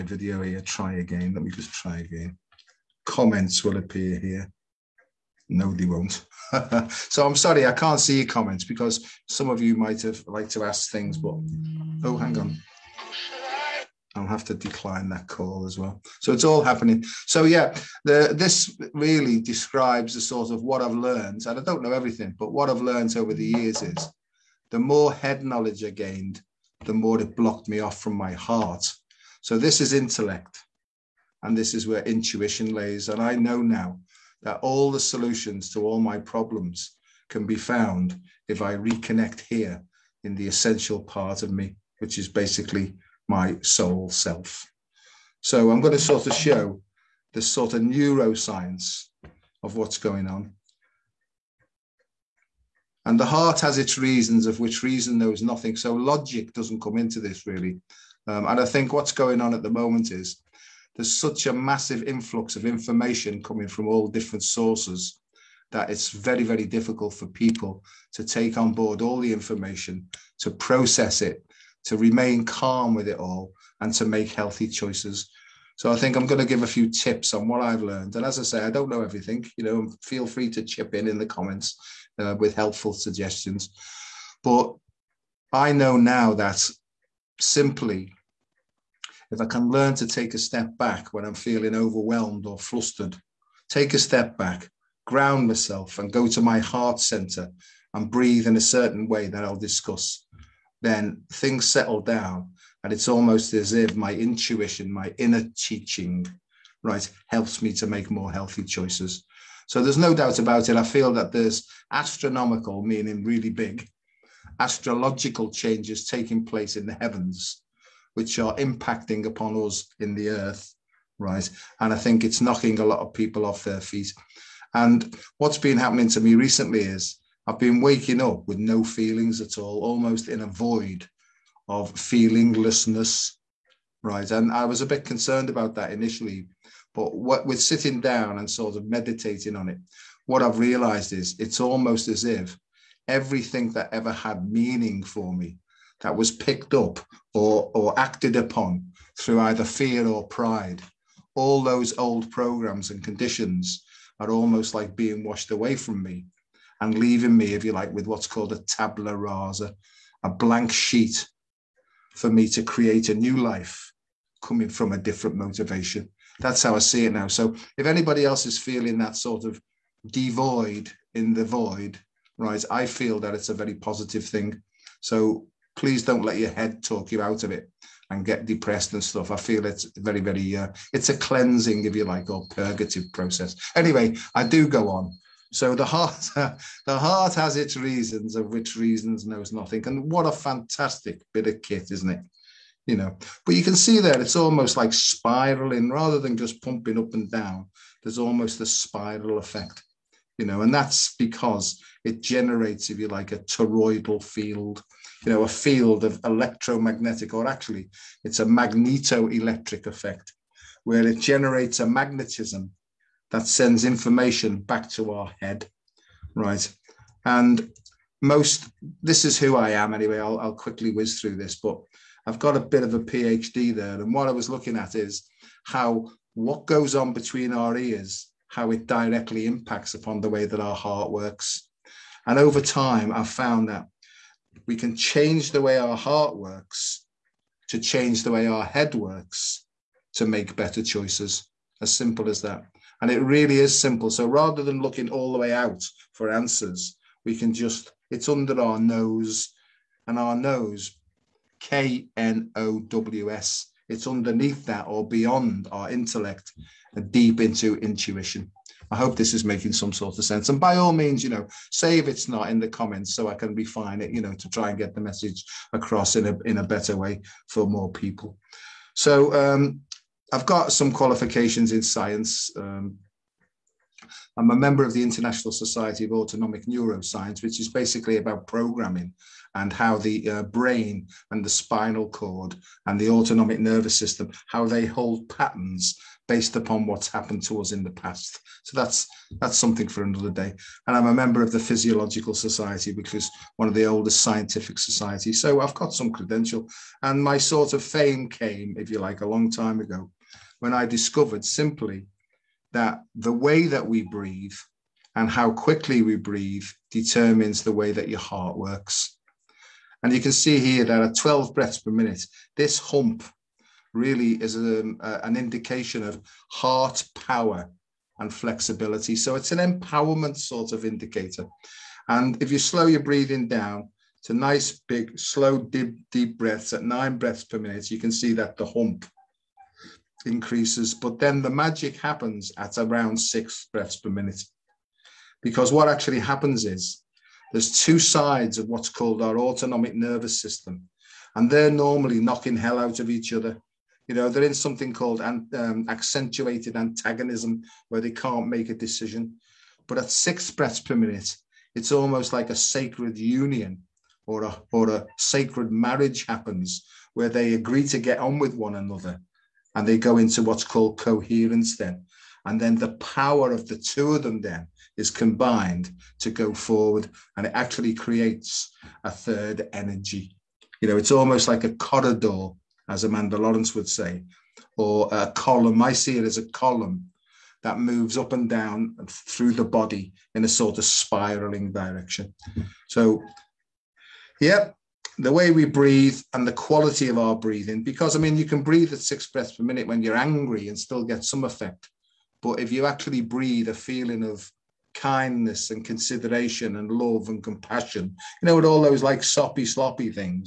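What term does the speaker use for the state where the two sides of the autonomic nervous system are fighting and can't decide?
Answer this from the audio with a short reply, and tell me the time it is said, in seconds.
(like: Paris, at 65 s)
accentuated antagonism, at 345 s.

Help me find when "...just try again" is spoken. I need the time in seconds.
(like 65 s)
1 s.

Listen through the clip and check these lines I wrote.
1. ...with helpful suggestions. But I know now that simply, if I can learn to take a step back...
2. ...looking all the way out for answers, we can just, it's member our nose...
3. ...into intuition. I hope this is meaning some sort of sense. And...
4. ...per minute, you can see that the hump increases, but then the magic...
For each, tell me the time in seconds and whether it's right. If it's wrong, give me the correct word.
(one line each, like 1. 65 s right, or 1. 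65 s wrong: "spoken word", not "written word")
1. 82 s right
2. 244 s wrong: "under", not "member"
3. 257 s wrong: "making", not "meaning"
4. 327 s right.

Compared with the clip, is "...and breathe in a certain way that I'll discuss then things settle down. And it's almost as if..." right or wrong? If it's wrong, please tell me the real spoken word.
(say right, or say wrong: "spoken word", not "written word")
right.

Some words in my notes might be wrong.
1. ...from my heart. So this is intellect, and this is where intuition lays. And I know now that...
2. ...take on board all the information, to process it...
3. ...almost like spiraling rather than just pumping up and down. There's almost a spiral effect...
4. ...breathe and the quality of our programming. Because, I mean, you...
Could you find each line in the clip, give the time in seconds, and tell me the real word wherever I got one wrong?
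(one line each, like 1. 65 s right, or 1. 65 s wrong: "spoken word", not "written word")
1. 27 s right
2. 68 s right
3. 194 s right
4. 385 s wrong: "breathing", not "programming".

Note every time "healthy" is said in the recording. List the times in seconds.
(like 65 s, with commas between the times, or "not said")
74 s, 108 s.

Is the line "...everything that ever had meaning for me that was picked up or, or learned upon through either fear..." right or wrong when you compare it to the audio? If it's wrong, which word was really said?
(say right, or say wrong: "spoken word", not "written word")
wrong: "acted", not "learned".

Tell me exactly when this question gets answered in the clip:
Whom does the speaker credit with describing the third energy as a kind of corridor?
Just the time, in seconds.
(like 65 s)
373 s.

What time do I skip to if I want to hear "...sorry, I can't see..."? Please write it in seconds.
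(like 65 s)
7 s.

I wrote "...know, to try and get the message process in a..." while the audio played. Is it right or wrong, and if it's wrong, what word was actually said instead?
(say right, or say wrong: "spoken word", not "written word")
wrong: "across", not "process".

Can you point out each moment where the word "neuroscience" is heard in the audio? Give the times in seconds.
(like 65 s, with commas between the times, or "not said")
47 s, 276 s.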